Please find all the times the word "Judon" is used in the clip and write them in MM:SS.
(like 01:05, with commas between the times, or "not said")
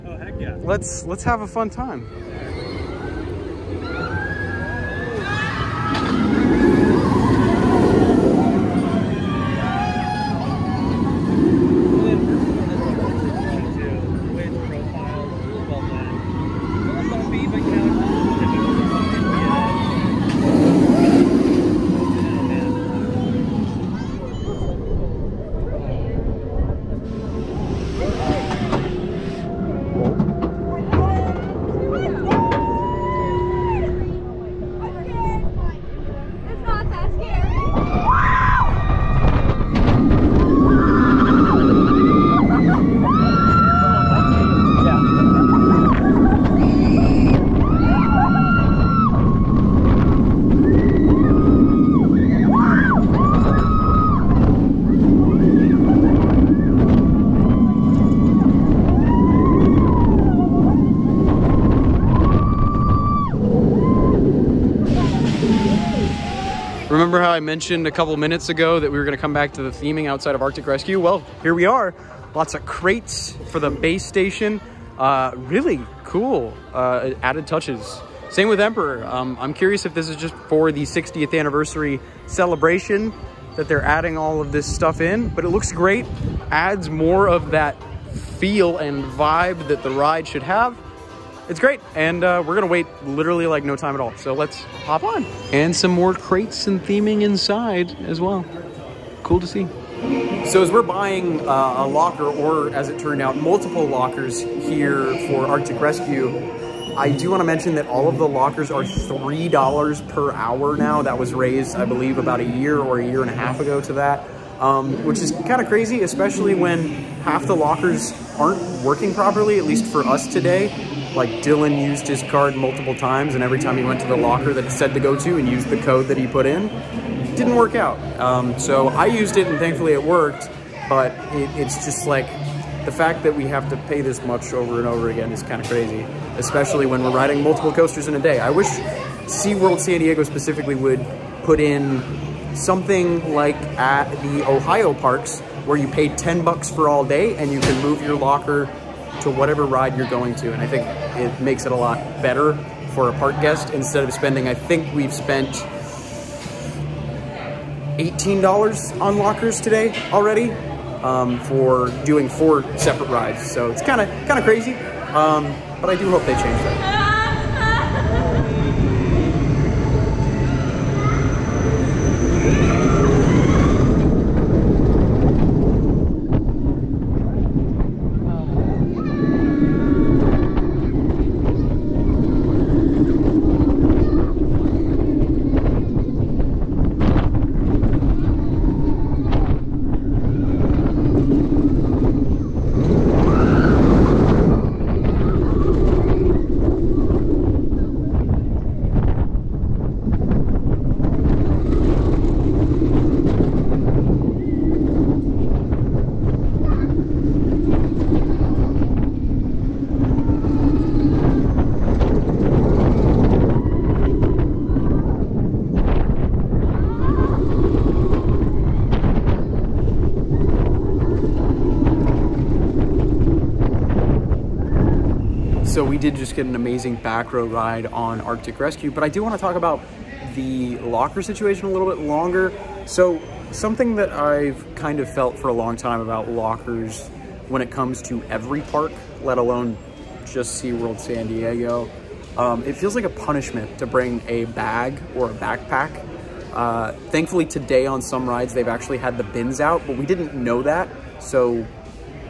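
not said.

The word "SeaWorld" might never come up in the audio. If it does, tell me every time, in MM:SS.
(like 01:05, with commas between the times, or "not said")
02:19, 04:00.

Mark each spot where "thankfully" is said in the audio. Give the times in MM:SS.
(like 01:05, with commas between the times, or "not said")
02:09, 04:07.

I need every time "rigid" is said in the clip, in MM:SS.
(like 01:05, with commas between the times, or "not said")
not said.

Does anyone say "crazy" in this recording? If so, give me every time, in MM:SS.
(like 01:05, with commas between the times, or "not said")
01:55, 02:15, 02:44.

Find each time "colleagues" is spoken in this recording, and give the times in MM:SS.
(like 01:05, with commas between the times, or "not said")
not said.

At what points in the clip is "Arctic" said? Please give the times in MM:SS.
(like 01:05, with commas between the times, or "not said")
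01:10, 01:45, 03:48.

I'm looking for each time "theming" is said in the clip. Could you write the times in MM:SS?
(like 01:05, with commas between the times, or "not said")
01:09, 01:36.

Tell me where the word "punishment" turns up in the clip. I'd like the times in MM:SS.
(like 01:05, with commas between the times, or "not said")
04:03.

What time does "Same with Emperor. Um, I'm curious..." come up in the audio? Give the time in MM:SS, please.
01:18.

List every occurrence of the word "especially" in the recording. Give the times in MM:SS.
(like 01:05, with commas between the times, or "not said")
01:56, 02:16.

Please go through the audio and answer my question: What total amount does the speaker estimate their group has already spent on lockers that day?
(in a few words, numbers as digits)
$18.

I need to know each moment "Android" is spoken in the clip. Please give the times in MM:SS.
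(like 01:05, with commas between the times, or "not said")
not said.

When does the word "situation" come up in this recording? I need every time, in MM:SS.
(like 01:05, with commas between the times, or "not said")
03:51.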